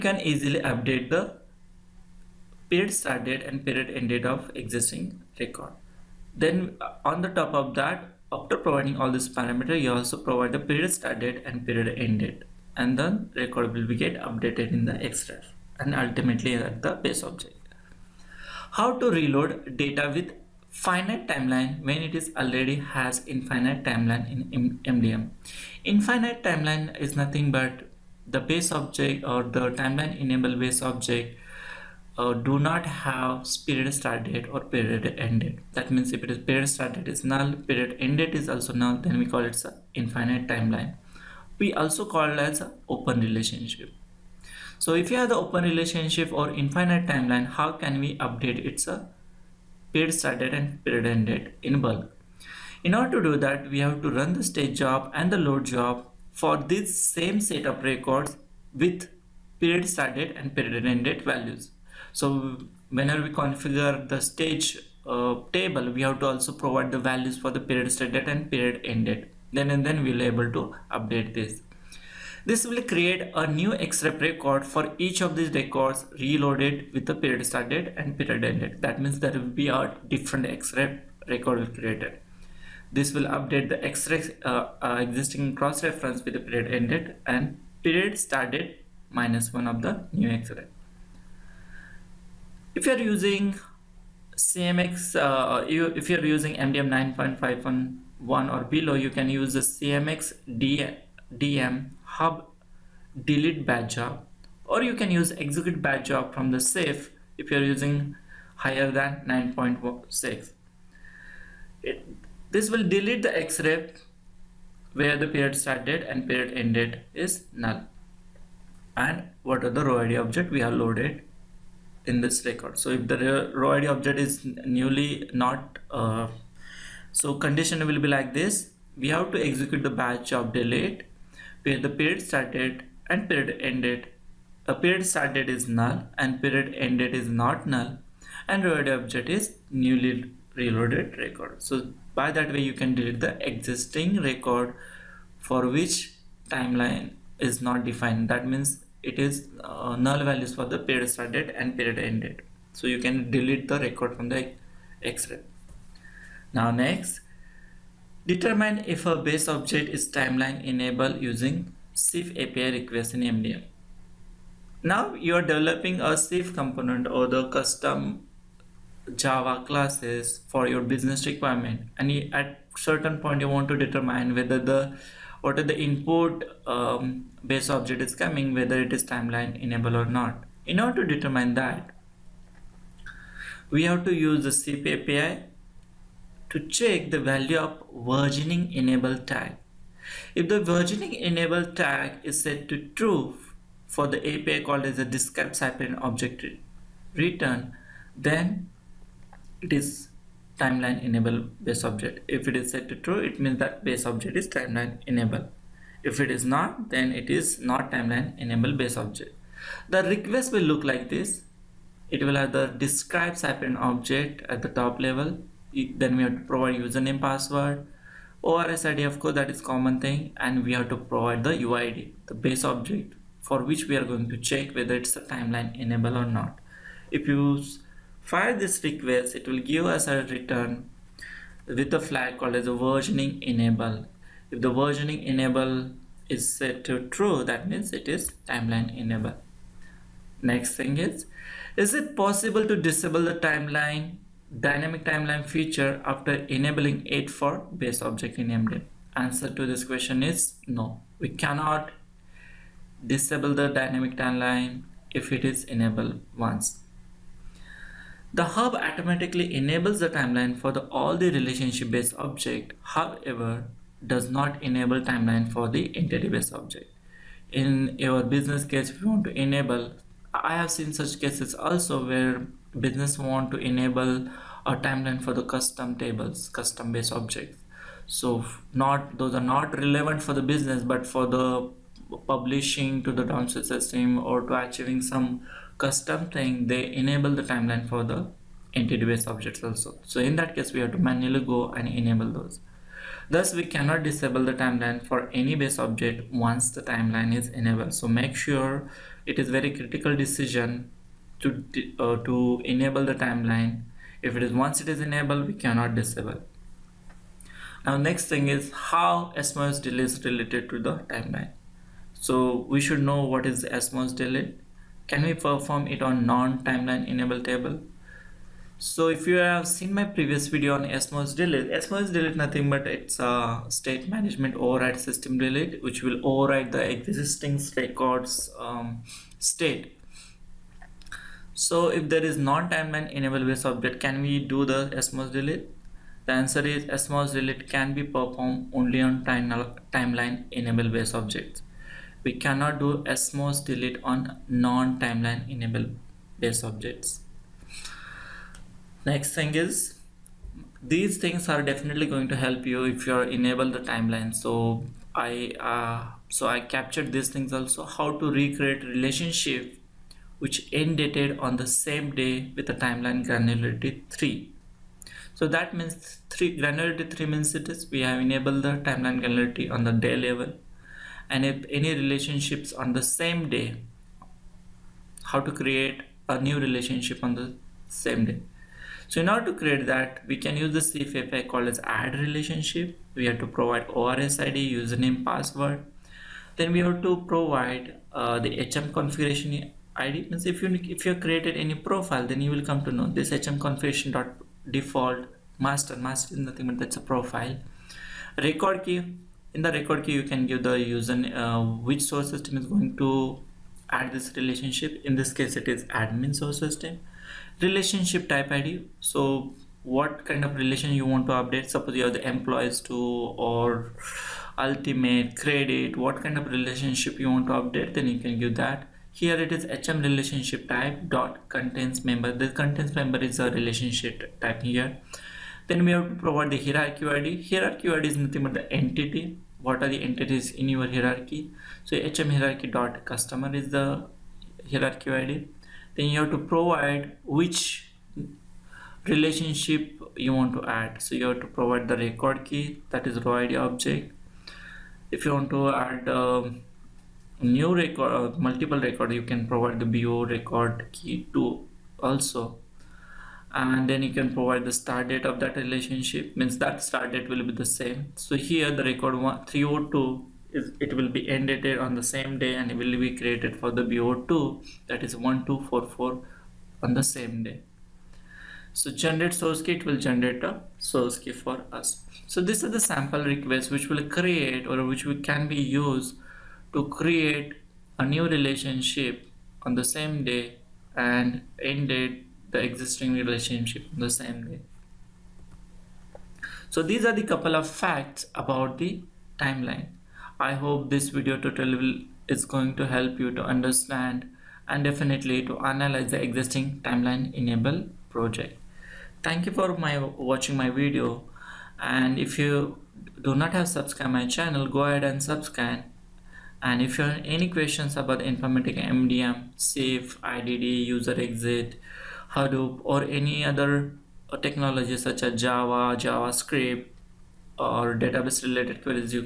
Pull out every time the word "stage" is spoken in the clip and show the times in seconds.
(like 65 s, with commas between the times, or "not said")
54 s, 64 s.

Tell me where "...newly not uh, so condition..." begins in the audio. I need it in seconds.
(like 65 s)
124 s.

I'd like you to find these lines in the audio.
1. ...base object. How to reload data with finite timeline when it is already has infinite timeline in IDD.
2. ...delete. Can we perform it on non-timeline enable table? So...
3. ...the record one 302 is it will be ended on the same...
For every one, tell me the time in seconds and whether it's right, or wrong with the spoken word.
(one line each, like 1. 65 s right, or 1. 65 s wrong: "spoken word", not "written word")
1. 17 s wrong: "MDM", not "IDD"
2. 314 s right
3. 458 s right.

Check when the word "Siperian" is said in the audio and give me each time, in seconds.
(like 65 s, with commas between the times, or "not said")
195 s, 213 s.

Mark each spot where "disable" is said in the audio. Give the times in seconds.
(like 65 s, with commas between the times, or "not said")
242 s, 253 s, 294 s, 305 s.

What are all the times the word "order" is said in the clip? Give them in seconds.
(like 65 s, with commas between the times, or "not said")
52 s, 180 s, 379 s.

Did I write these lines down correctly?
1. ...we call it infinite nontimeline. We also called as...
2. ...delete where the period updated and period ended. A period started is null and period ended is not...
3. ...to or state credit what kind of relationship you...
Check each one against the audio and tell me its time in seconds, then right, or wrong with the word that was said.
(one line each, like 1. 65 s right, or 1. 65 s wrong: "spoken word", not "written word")
1. 39 s wrong: "timeline", not "nontimeline"
2. 130 s wrong: "started", not "updated"
3. 412 s wrong: "ultimate", not "state".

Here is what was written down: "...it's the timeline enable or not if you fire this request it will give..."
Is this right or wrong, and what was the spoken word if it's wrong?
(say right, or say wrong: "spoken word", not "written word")
right.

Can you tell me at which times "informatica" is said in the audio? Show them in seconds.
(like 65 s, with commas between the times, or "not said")
508 s.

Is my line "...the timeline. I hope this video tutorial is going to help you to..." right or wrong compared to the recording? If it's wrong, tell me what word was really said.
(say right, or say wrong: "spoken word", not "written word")
right.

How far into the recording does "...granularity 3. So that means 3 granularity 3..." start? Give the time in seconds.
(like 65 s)
363 s.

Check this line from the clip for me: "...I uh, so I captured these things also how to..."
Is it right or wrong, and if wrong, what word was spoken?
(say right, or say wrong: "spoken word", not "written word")
right.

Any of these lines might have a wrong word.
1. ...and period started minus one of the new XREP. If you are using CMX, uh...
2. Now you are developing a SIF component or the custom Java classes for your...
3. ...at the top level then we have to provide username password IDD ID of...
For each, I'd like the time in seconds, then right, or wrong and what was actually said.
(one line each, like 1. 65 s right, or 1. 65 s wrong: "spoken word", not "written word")
1. 87 s right
2. 164 s right
3. 214 s wrong: "ORS", not "IDD".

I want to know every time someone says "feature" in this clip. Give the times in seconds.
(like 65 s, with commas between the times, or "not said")
245 s.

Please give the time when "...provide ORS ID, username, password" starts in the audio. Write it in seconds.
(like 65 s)
383 s.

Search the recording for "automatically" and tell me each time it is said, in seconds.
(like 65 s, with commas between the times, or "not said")
258 s.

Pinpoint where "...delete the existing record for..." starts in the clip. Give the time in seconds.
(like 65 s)
142 s.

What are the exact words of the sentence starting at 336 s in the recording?
The answer is SMOS delete can be performed only on time, timeline enable based objects.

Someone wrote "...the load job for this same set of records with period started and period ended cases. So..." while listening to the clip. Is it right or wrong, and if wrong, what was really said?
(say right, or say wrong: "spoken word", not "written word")
wrong: "values", not "cases".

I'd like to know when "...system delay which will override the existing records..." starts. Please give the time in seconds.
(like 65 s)
324 s.